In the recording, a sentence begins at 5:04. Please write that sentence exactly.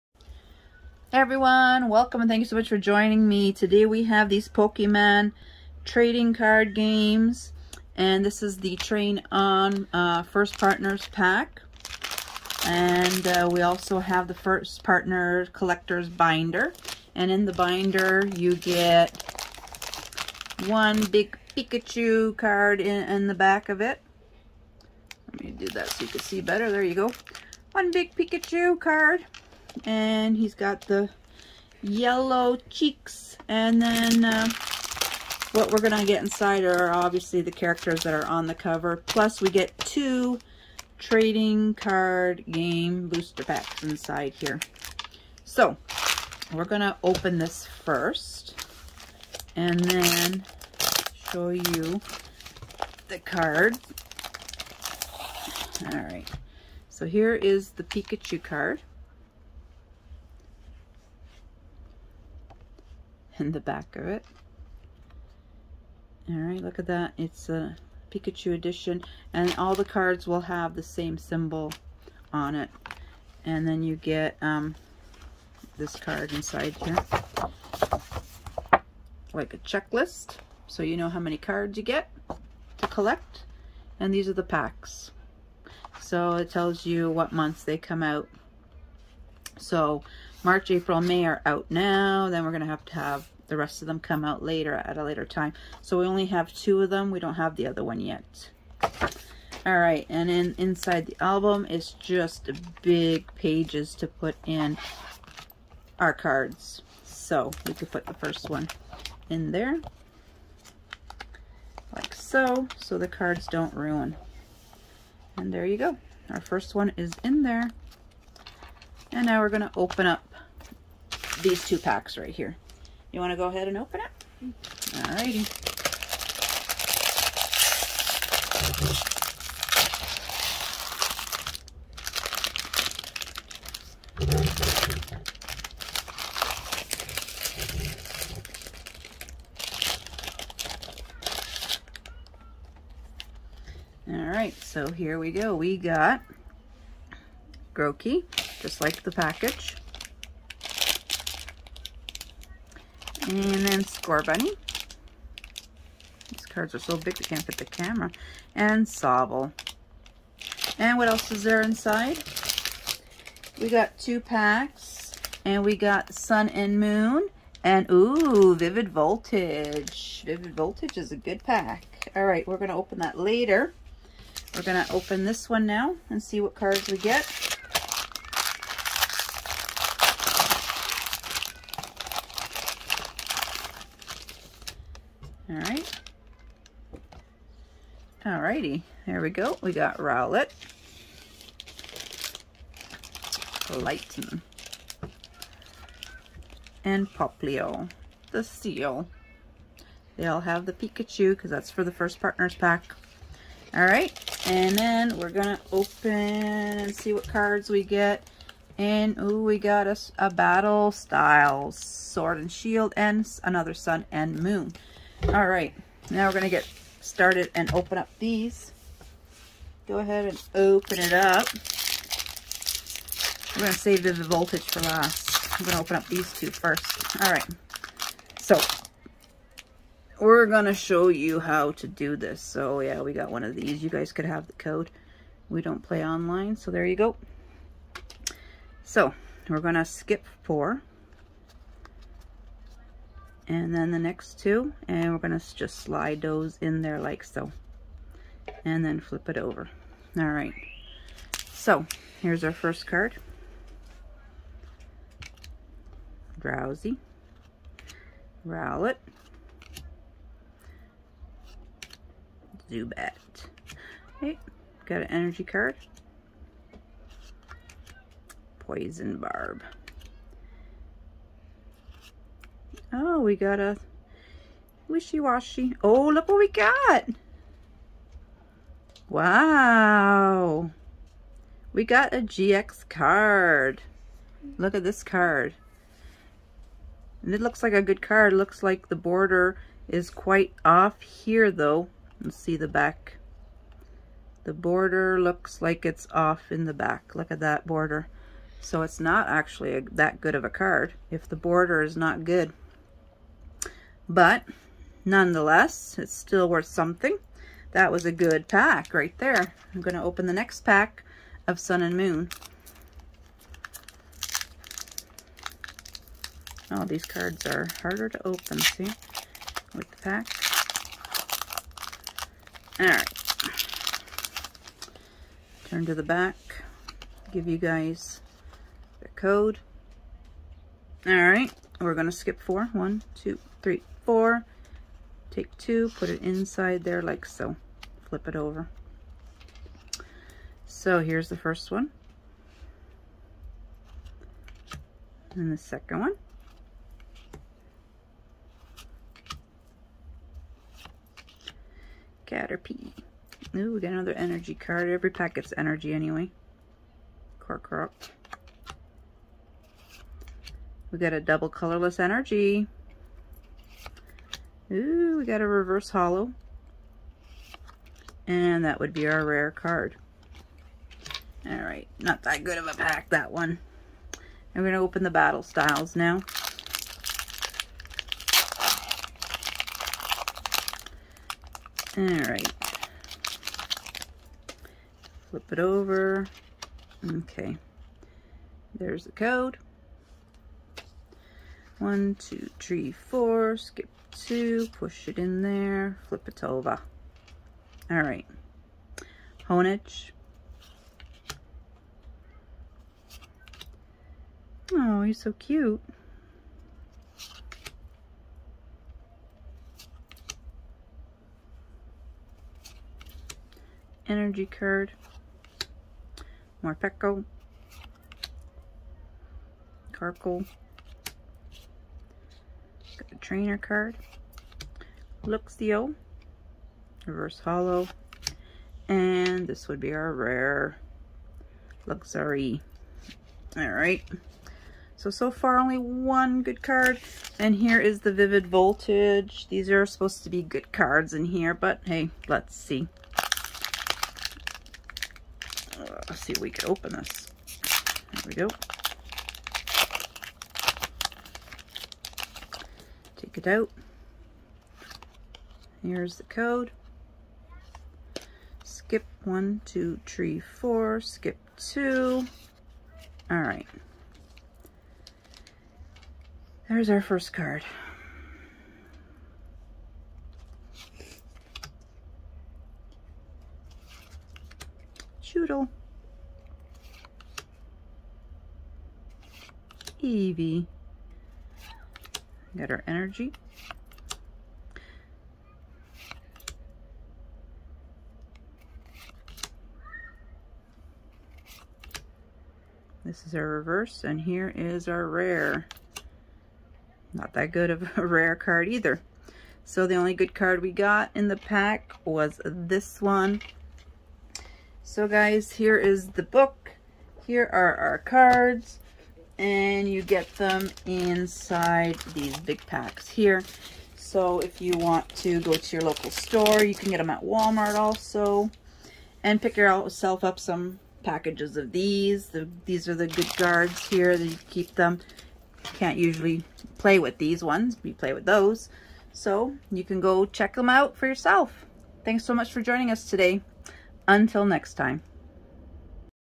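But nonetheless, it's still worth something.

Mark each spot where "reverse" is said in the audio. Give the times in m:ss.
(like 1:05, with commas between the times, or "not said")
6:05, 7:07, 8:13.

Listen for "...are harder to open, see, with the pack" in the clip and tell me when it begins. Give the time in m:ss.
5:17.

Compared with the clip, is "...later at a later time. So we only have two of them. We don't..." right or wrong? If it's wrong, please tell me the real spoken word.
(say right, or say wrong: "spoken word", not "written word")
right.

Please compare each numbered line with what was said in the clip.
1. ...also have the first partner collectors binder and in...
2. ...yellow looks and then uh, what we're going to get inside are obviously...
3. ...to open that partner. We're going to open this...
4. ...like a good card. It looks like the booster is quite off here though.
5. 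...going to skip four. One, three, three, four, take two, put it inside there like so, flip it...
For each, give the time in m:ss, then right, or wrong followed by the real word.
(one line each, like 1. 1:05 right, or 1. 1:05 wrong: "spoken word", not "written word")
1. 0:13 right
2. 0:31 wrong: "cheeks", not "looks"
3. 2:52 wrong: "later", not "partner"
4. 4:47 wrong: "border", not "booster"
5. 5:31 wrong: "two", not "three".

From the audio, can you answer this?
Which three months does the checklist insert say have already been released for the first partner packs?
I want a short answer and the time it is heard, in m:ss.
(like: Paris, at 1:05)
March, April, May, at 1:30.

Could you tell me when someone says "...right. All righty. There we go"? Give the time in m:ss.
3:05.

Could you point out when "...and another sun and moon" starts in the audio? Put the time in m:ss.
3:32.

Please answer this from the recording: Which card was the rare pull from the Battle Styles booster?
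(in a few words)
Luxray.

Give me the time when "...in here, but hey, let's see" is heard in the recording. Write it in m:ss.
7:21.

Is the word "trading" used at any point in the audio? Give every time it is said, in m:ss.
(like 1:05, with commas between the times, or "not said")
0:05, 0:40.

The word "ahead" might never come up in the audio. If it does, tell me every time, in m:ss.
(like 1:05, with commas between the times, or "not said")
2:03, 3:39.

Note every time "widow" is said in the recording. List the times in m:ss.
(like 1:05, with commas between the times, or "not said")
not said.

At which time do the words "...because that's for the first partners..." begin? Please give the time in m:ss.
3:21.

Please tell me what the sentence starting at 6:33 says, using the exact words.
Skip two, push it in there, flip it over.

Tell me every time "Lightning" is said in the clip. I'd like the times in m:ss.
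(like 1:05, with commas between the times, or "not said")
3:13.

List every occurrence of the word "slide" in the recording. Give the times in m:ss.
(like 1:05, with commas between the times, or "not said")
4:05.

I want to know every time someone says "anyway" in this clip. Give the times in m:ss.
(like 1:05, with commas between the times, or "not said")
5:55.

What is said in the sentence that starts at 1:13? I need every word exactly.
And then you get um, this card inside here.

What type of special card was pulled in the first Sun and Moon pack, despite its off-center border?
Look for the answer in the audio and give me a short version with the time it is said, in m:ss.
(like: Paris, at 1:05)
GX card, at 4:42.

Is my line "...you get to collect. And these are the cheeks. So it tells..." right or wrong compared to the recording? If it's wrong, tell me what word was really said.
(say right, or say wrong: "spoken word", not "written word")
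wrong: "packs", not "cheeks".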